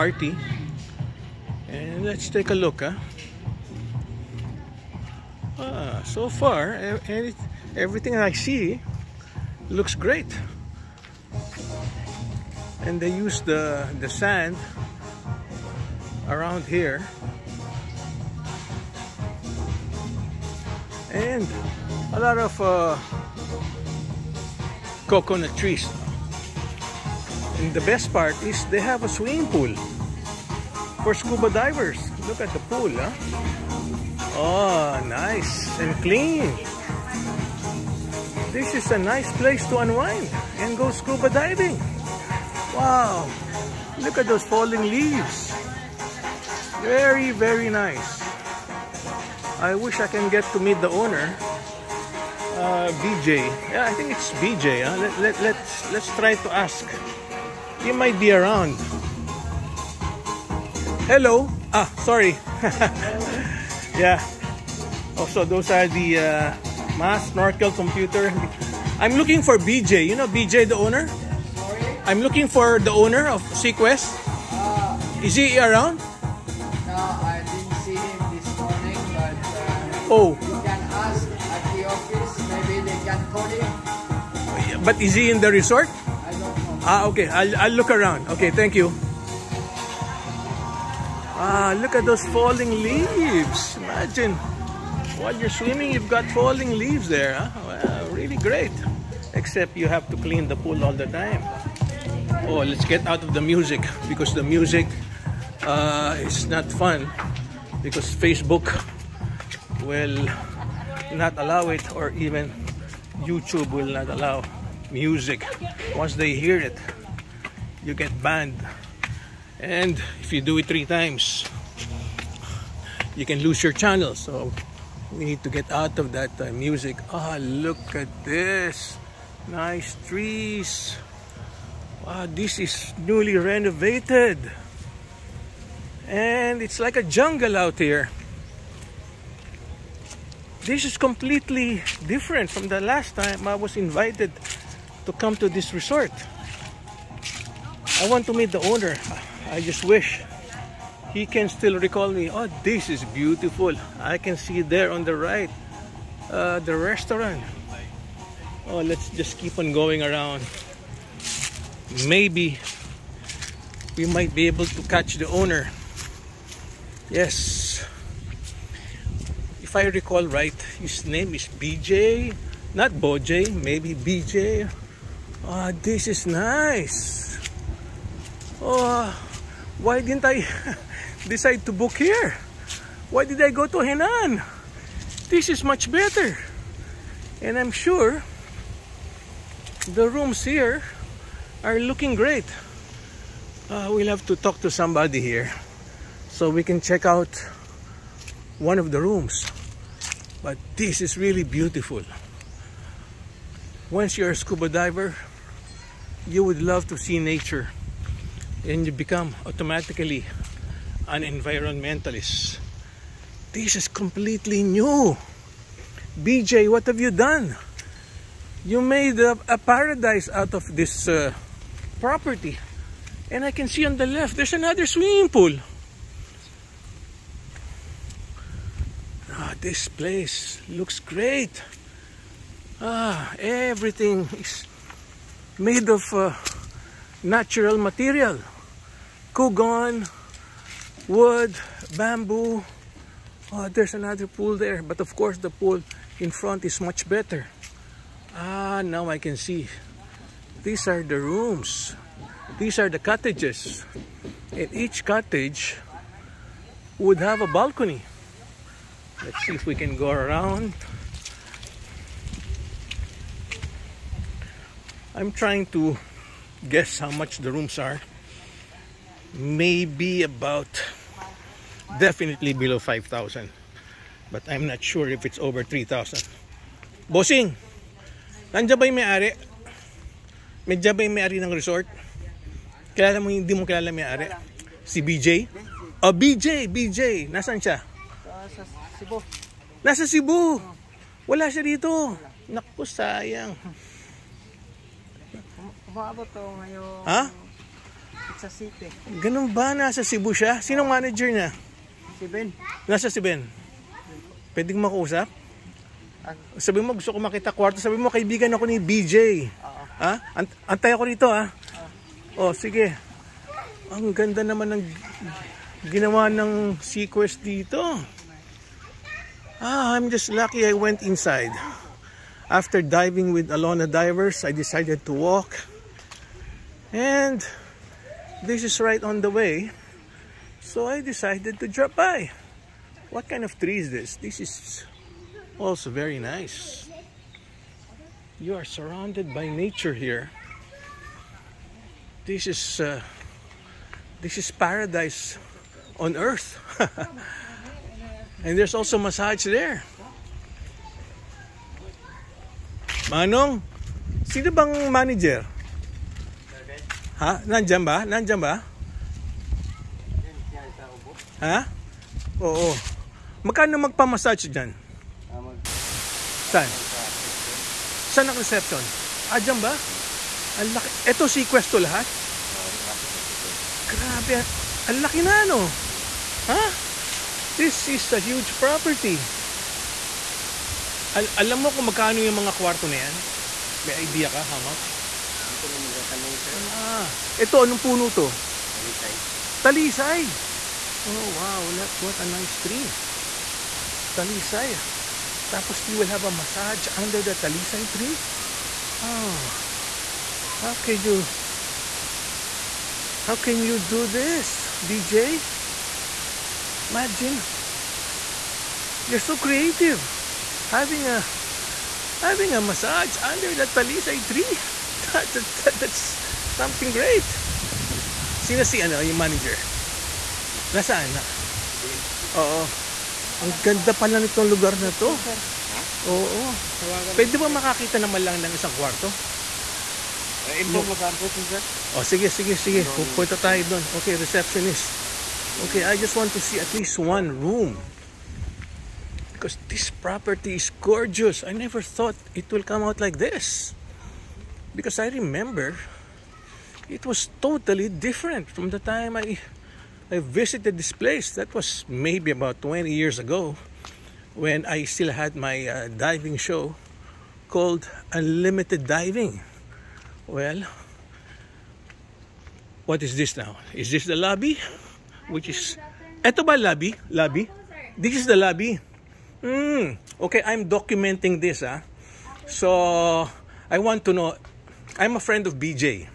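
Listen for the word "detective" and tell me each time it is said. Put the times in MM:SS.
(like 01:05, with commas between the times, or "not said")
not said.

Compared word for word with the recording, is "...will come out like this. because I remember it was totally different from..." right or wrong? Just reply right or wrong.
right.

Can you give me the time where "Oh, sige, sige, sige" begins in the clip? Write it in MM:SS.
07:11.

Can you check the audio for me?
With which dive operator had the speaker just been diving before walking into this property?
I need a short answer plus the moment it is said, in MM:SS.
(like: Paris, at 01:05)
Alona Divers, at 05:23.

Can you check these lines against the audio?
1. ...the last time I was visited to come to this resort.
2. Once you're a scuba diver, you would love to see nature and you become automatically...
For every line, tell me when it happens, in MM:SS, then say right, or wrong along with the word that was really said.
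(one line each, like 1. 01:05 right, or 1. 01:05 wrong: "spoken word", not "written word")
1. 02:22 wrong: "invited", not "visited"
2. 03:23 right.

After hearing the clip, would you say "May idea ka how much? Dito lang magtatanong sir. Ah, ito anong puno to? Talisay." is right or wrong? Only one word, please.
right.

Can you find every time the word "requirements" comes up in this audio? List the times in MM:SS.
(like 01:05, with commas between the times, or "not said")
not said.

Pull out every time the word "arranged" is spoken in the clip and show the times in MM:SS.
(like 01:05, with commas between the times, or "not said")
not said.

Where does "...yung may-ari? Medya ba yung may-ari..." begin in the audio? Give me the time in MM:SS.
04:38.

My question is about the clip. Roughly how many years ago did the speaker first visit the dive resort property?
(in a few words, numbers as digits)
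20.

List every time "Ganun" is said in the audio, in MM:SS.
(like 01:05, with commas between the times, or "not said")
04:59.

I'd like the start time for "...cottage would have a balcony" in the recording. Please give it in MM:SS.
04:15.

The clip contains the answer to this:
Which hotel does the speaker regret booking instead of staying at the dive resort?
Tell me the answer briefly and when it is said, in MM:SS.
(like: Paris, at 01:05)
Henann, at 03:03.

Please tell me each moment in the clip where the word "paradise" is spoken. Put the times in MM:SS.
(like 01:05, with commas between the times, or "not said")
03:39, 05:44.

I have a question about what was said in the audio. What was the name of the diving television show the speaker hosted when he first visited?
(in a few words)
Unlimited Diving.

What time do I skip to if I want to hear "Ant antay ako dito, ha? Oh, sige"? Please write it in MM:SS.
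05:10.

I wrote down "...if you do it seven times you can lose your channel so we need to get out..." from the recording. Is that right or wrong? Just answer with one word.
wrong.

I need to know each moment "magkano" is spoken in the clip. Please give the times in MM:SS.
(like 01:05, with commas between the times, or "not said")
06:03, 06:21.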